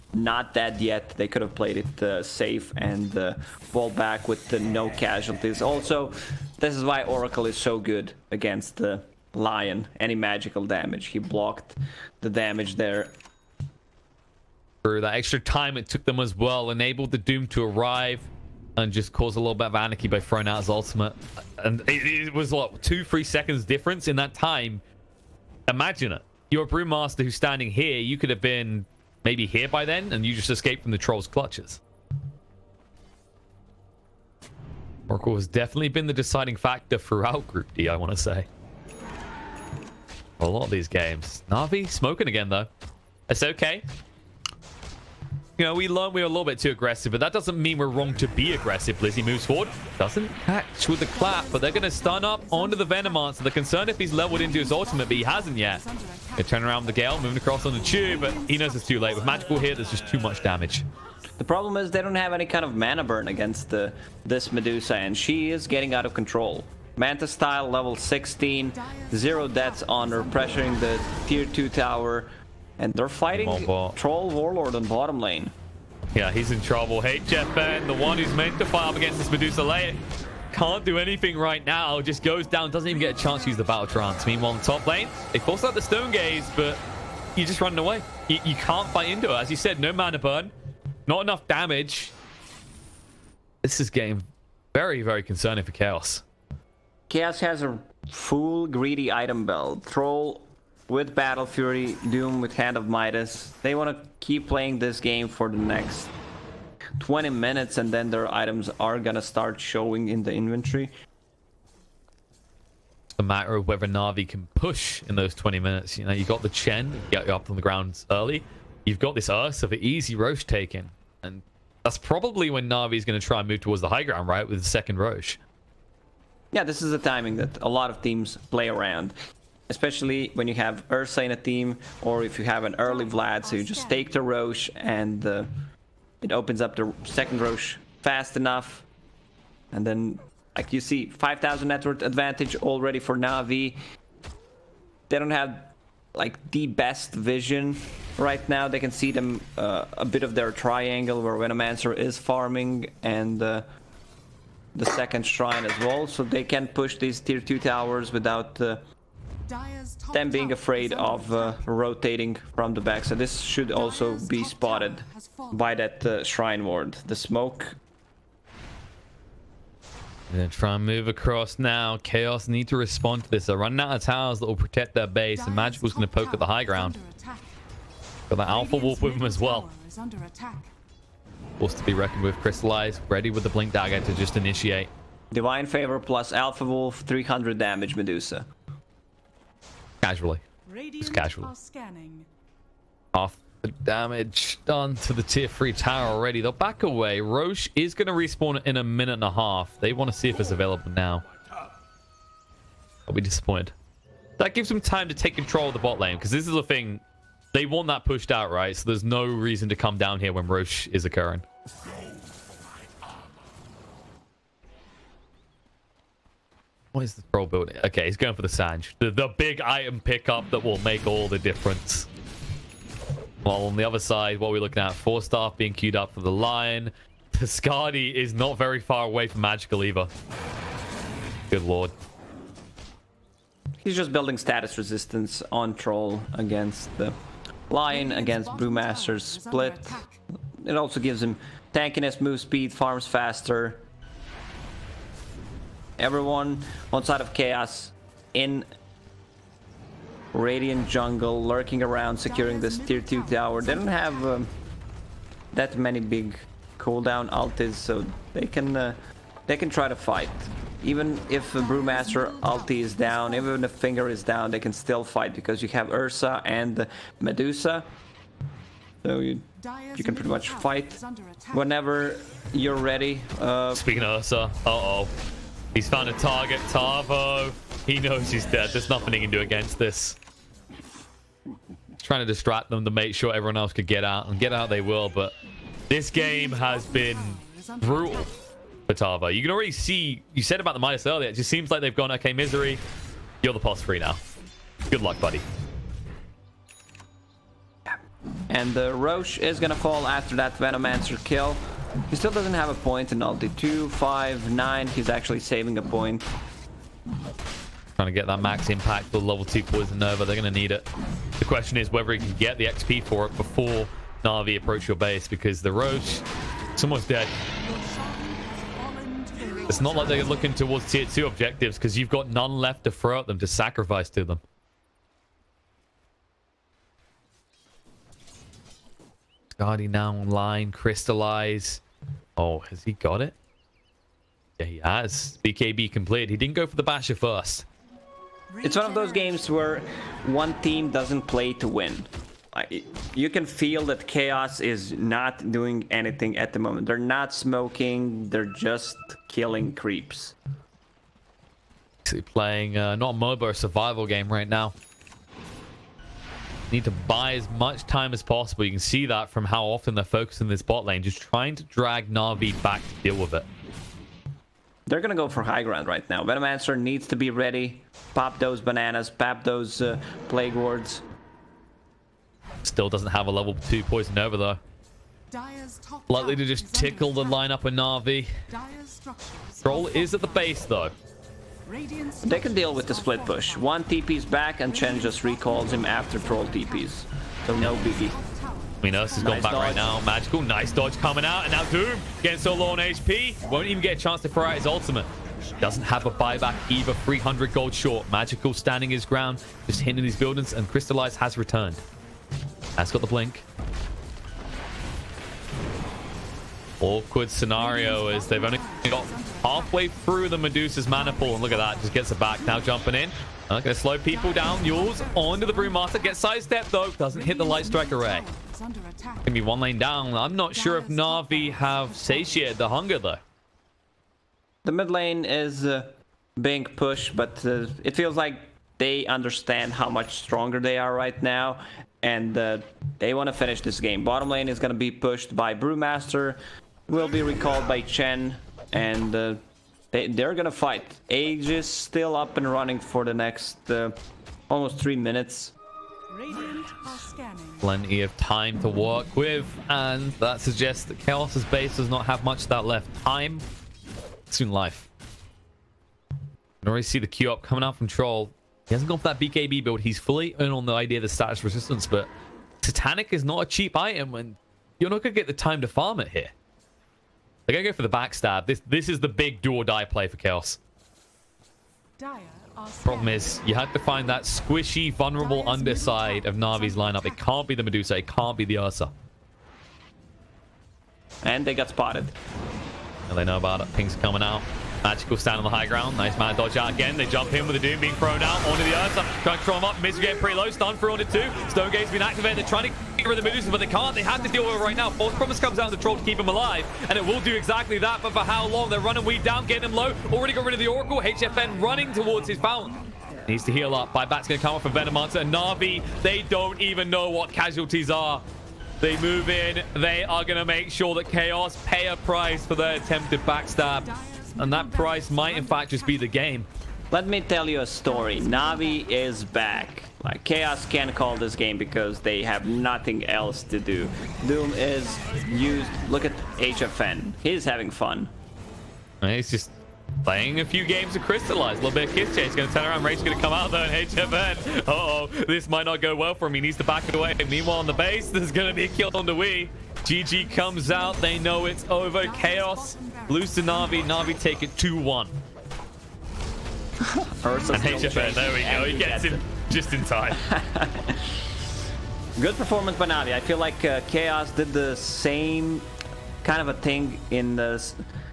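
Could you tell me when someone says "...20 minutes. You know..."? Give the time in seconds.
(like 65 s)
115 s.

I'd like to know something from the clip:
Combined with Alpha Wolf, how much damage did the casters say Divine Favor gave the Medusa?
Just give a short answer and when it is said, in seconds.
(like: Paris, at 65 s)
300, at 187 s.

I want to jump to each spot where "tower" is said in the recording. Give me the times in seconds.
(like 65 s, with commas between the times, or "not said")
71 s, 157 s, 174 s, 195 s, 253 s.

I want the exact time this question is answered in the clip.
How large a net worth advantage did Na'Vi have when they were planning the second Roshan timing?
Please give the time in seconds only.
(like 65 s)
141 s.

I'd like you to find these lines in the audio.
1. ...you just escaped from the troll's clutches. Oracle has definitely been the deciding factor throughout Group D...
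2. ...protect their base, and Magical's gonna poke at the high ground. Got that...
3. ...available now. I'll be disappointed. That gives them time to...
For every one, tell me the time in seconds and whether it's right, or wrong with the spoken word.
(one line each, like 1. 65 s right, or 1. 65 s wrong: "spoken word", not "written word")
1. 30 s right
2. 174 s right
3. 200 s right.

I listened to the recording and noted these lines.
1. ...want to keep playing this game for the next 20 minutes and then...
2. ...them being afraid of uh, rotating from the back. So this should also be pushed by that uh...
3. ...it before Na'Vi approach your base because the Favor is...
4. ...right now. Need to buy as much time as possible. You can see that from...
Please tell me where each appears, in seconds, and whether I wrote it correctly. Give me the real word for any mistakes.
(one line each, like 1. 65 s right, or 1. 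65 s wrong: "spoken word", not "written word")
1. 103 s right
2. 160 s wrong: "spotted", not "pushed"
3. 313 s wrong: "Rosh", not "Favor"
4. 354 s right.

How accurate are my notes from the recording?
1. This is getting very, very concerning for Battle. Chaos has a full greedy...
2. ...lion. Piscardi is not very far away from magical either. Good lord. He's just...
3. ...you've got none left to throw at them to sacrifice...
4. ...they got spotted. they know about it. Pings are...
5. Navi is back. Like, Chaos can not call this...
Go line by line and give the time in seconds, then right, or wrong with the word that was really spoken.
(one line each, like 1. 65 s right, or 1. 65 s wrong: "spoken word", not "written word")
1. 93 s wrong: "Chaos", not "Battle"
2. 226 s right
3. 321 s right
4. 481 s right
5. 518 s right.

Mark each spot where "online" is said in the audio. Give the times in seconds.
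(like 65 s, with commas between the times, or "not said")
330 s.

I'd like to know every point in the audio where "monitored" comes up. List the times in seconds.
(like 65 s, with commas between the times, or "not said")
not said.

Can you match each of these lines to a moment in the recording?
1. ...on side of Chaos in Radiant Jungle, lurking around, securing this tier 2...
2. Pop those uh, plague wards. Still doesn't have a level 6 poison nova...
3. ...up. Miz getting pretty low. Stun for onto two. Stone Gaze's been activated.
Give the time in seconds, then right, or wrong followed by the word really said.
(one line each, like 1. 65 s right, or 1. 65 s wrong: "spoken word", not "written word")
1. 246 s right
2. 369 s wrong: "2", not "6"
3. 489 s right.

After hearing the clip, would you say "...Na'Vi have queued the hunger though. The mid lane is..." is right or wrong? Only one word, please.
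wrong.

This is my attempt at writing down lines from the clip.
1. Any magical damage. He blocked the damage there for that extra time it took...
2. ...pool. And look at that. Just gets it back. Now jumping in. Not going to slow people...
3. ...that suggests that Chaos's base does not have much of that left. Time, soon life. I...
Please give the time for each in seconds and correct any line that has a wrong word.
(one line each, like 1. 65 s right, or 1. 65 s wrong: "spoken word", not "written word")
1. 10 s right
2. 411 s right
3. 450 s right.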